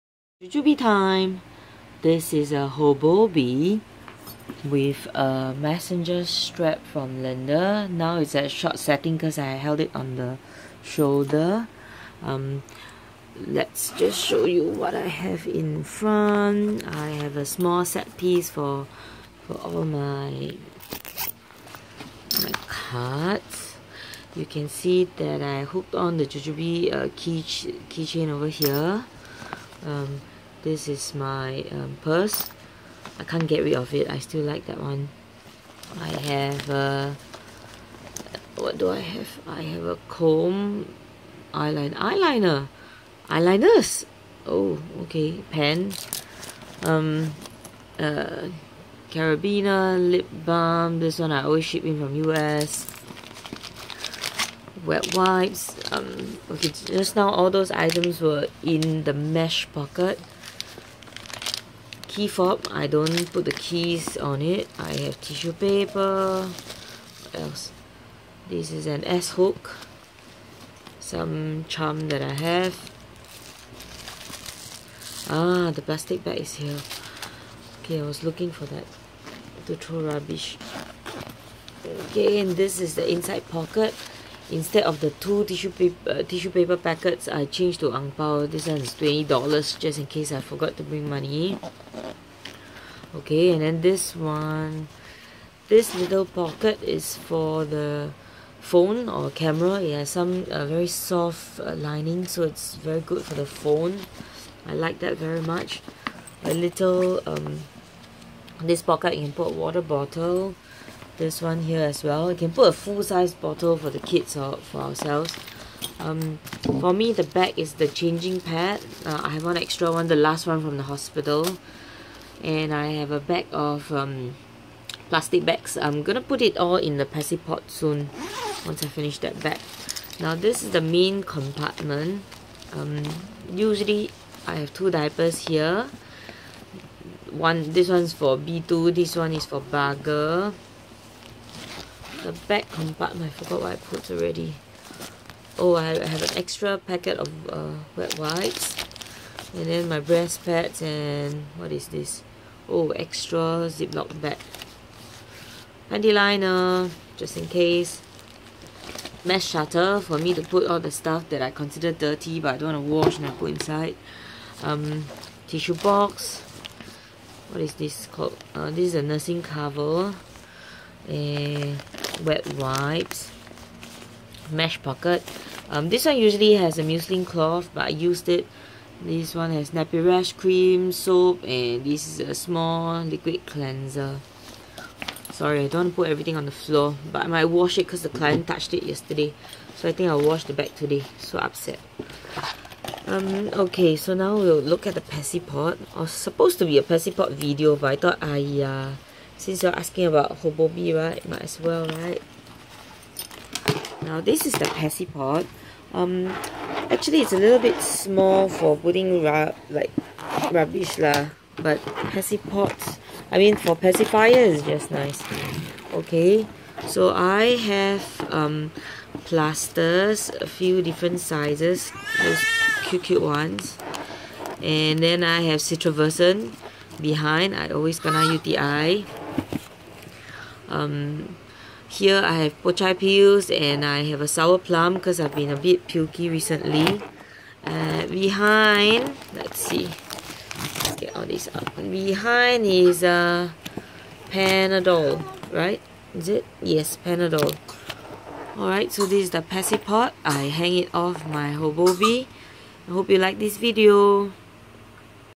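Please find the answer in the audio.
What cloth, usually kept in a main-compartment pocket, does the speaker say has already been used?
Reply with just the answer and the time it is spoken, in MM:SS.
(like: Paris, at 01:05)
muslin cloth, at 02:56.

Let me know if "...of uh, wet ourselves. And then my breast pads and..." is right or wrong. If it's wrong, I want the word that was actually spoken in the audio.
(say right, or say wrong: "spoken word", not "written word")
wrong: "wipes", not "ourselves".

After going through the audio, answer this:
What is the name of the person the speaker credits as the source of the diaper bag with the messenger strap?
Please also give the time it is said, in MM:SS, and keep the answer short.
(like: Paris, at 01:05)
Linda, at 00:07.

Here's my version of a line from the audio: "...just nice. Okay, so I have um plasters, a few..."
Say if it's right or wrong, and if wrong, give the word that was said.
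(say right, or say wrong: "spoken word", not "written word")
right.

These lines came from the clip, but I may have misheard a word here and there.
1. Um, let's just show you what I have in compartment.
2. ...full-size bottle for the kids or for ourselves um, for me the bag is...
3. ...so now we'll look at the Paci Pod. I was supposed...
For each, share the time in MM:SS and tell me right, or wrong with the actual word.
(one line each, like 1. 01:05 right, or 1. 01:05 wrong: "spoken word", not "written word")
1. 00:12 wrong: "front", not "compartment"
2. 01:52 right
3. 03:13 right.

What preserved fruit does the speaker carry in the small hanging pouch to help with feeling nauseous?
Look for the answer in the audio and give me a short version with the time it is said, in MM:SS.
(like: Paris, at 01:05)
sour plum, at 03:54.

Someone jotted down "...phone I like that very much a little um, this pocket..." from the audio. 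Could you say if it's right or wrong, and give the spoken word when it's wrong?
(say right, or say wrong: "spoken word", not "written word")
right.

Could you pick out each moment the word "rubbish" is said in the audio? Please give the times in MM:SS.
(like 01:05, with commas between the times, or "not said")
01:20, 03:30.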